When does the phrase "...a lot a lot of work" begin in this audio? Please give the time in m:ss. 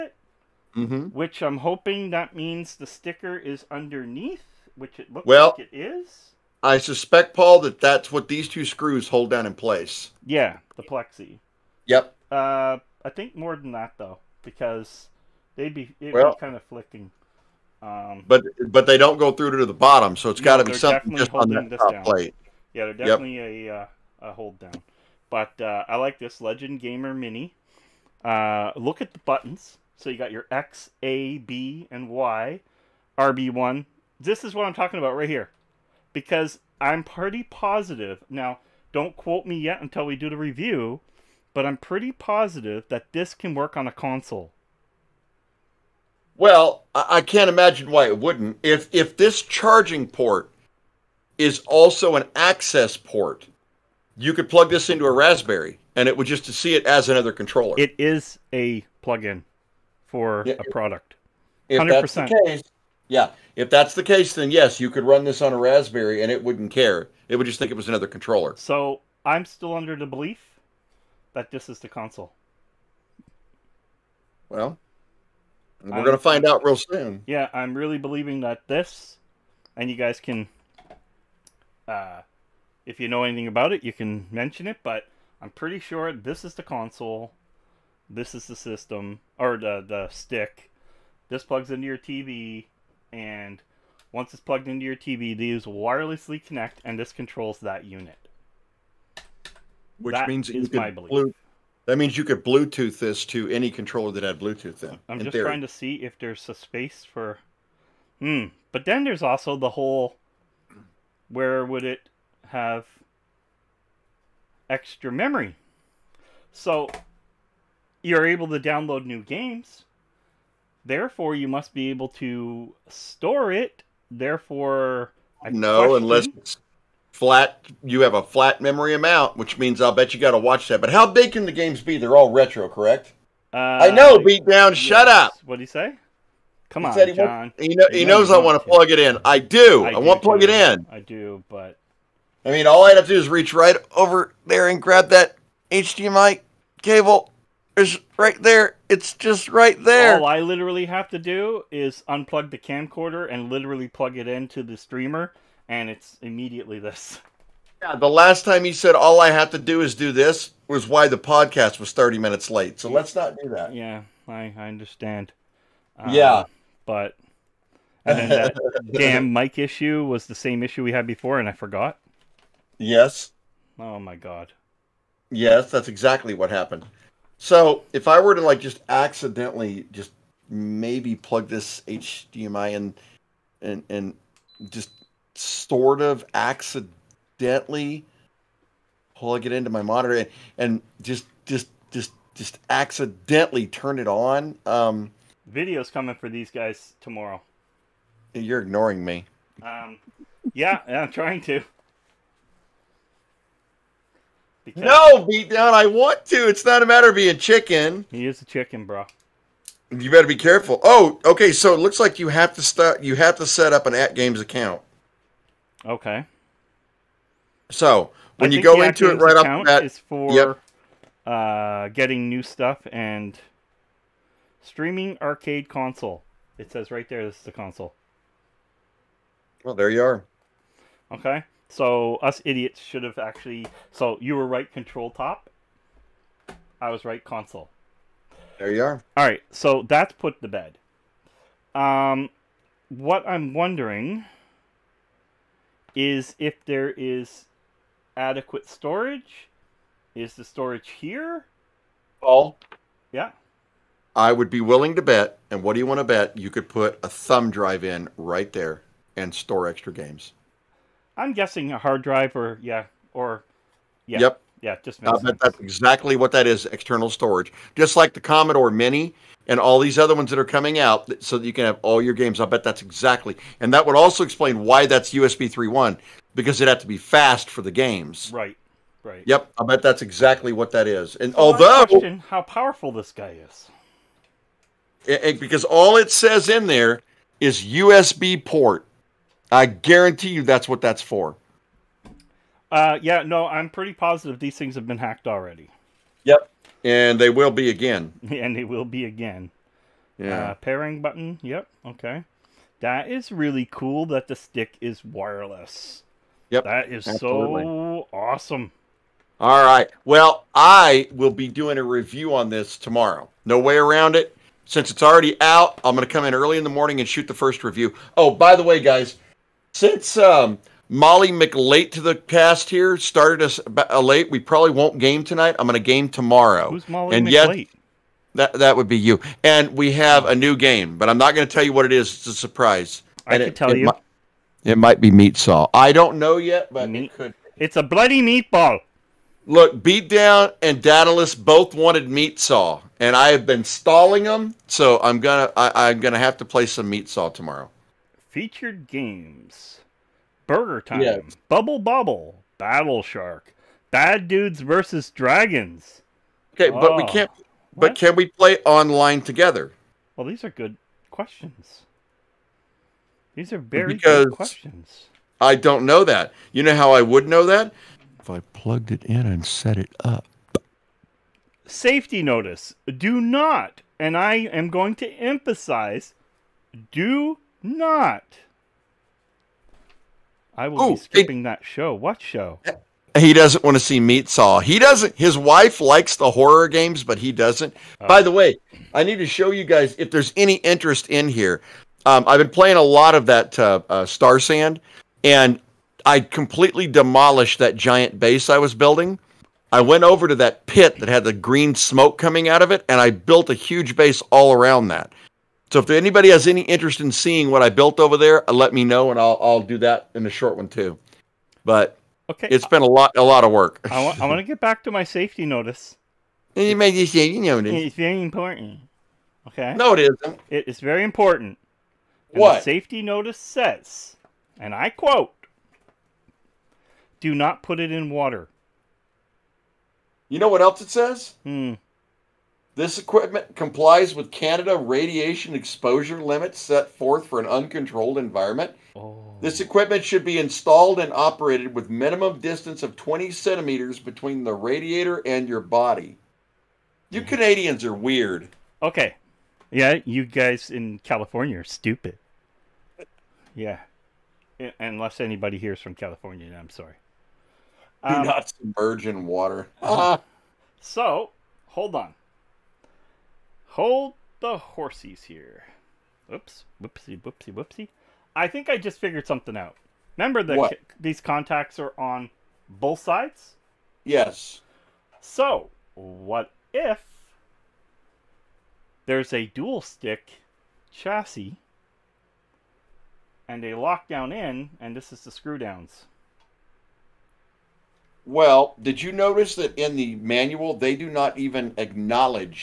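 6:52.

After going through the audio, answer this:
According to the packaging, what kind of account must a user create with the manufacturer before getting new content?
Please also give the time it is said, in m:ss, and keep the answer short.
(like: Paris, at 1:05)
AtGames account, at 3:33.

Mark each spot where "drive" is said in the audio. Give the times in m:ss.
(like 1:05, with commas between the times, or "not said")
4:17, 4:22.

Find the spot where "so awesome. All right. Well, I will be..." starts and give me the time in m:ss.
5:07.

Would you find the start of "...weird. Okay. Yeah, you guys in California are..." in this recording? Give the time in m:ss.
7:27.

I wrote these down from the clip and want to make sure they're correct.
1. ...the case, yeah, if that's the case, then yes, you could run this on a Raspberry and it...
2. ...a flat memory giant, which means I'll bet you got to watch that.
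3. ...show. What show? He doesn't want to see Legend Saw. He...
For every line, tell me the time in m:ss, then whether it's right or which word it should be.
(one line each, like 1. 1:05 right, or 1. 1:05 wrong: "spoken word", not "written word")
1. 1:02 right
2. 2:08 wrong: "amount", not "giant"
3. 6:21 wrong: "Meat", not "Legend".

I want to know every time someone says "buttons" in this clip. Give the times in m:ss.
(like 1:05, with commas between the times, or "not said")
0:29, 5:01.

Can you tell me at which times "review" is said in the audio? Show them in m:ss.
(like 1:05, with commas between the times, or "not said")
0:40, 5:11, 5:17.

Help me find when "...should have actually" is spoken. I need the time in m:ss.
3:52.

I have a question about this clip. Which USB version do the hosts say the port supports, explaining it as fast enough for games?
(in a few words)
USB 3.1.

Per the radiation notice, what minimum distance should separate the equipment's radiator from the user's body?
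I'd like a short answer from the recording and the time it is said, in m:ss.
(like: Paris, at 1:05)
20 centimeters, at 7:22.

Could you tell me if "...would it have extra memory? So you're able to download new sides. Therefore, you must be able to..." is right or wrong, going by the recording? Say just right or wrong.
wrong.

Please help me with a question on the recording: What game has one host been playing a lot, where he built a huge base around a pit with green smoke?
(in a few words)
Starsand.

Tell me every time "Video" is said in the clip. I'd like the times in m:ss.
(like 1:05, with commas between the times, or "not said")
3:15.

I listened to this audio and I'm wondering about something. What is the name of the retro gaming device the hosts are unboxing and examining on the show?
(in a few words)
Legend Gamer Mini.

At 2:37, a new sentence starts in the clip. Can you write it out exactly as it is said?
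Yeah, the last time you said all I have to do is do this was why the podcast was 30 minutes late.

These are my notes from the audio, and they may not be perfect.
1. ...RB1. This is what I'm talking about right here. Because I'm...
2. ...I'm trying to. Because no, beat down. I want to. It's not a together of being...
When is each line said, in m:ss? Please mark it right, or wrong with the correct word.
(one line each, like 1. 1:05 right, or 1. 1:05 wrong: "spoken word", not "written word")
1. 0:33 right
2. 3:20 wrong: "matter", not "together".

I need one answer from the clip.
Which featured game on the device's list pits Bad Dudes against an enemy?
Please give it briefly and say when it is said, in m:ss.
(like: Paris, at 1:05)
Bad Dudes versus Dragons, at 5:53.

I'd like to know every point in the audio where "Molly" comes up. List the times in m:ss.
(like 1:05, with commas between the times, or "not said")
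5:20, 5:26.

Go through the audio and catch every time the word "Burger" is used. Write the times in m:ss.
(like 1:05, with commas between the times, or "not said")
5:50.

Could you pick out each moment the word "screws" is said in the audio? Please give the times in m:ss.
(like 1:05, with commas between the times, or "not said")
0:08, 8:05.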